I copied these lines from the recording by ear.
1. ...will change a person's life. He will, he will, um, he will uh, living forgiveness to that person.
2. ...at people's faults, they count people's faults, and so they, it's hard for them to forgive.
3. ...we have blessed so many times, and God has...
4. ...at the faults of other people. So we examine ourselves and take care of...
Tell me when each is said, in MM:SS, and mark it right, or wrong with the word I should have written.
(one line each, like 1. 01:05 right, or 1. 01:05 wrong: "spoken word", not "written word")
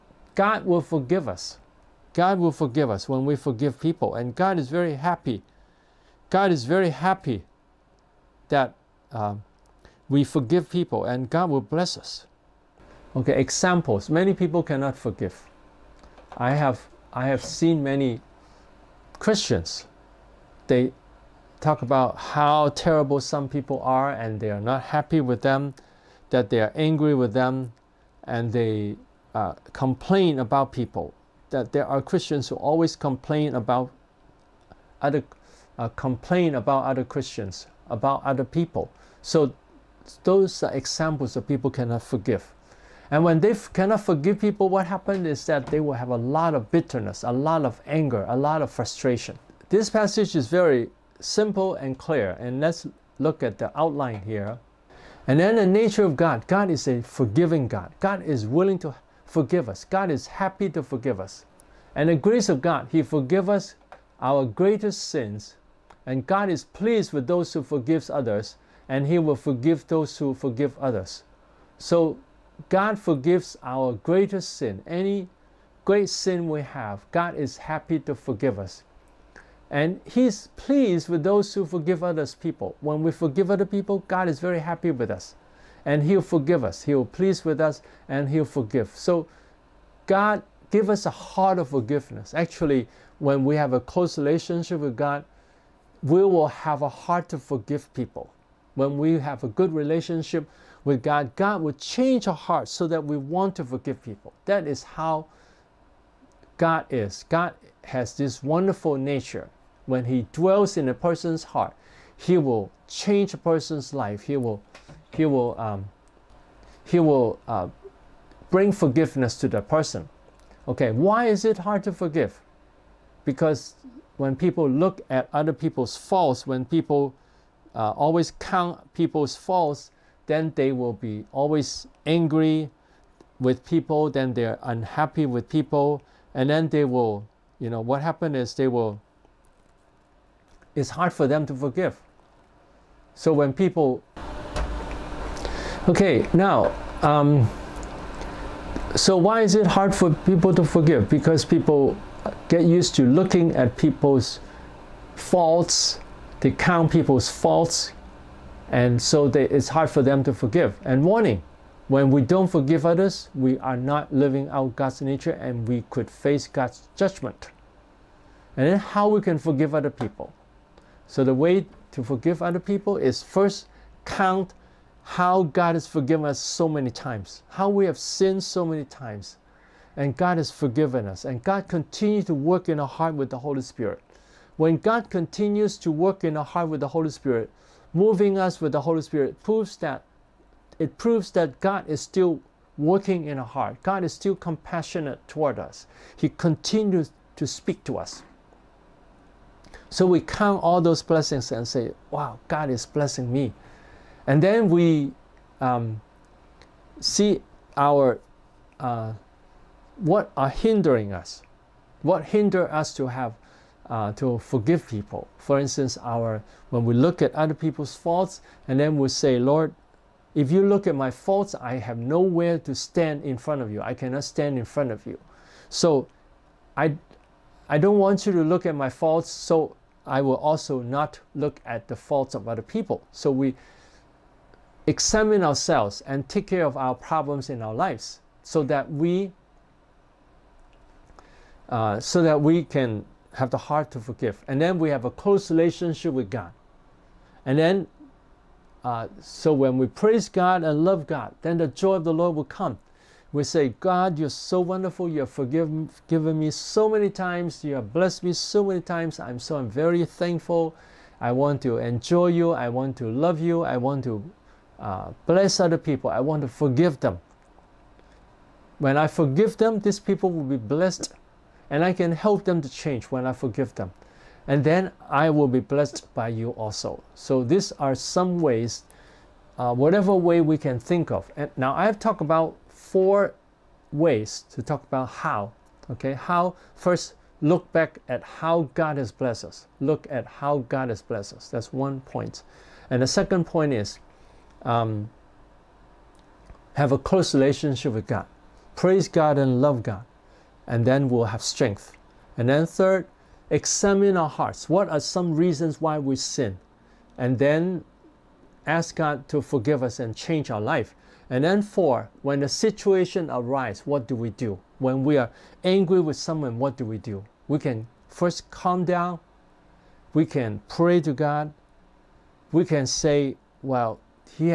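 1. 01:52 wrong: "bring", not "living"
2. 02:33 right
3. 02:57 wrong: "sinned", not "blessed"
4. 03:51 right.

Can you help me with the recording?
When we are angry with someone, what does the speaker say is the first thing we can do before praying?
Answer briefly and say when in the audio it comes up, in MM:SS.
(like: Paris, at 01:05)
calm down, at 05:18.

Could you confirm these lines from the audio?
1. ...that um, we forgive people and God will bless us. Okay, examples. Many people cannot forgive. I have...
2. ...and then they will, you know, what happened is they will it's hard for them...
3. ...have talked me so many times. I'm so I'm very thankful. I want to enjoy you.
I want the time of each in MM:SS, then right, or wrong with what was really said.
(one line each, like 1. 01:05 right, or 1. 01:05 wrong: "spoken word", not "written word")
1. 00:08 right
2. 02:16 right
3. 04:17 wrong: "blessed", not "talked".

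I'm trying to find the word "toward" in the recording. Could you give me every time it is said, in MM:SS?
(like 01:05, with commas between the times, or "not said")
03:15.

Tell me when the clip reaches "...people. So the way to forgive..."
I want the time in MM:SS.
02:49.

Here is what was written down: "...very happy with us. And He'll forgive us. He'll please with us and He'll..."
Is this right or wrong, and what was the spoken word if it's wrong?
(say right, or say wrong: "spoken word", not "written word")
right.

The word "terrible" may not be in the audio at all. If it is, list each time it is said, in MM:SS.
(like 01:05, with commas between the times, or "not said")
00:22.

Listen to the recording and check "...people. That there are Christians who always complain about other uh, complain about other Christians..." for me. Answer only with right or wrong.
right.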